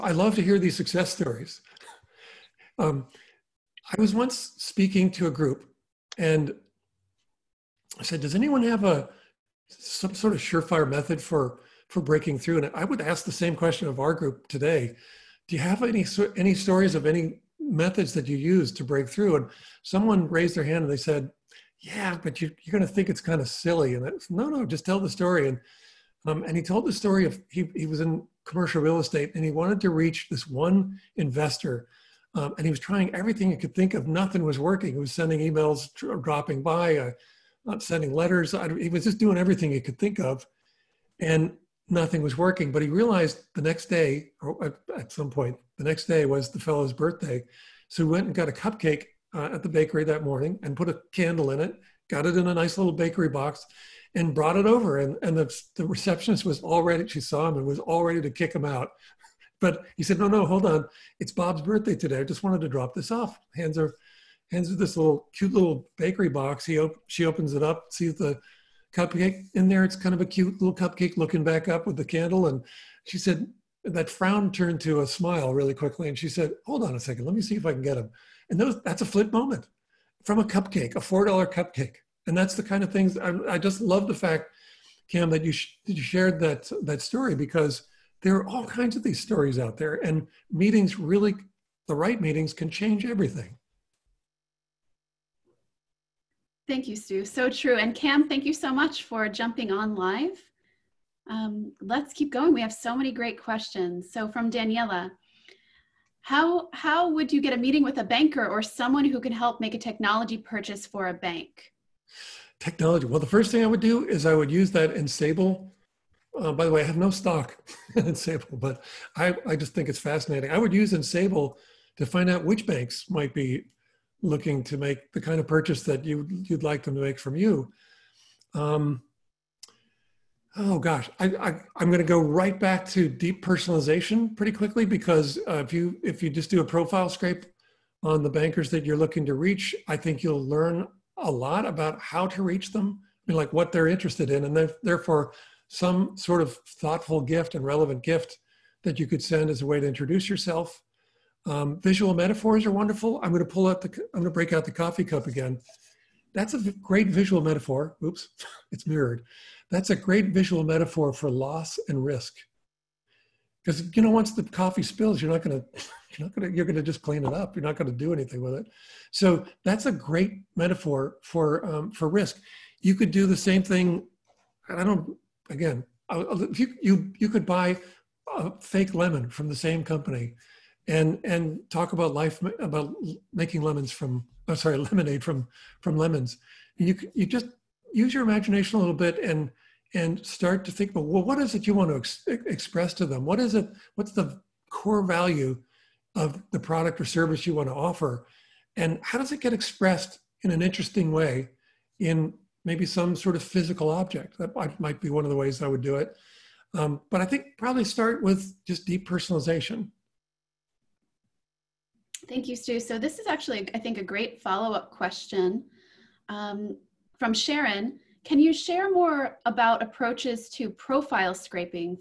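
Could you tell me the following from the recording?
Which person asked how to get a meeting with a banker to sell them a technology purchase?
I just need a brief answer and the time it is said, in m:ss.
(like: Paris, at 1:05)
Daniela, at 1:44.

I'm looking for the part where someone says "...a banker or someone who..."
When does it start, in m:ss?
1:47.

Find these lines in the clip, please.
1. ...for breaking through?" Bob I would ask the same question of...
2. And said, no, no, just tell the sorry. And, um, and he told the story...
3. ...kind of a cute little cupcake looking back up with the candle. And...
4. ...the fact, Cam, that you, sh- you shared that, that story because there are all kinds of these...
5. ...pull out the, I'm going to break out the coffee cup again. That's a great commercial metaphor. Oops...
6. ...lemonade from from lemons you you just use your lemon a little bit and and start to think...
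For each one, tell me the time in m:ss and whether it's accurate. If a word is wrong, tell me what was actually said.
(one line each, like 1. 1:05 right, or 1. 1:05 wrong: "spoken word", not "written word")
1. 0:11 wrong: "And", not "Bob"
2. 0:23 wrong: "story", not "sorry"
3. 1:09 right
4. 1:24 right
5. 2:33 wrong: "visual", not "commercial"
6. 3:04 wrong: "imagination", not "lemon".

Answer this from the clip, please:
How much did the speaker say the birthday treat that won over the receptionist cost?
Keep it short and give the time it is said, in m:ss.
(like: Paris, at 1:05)
$4, at 1:21.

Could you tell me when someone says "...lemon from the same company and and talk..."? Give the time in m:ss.
2:58.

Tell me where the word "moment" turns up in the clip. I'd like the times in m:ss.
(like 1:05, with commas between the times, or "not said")
1:19.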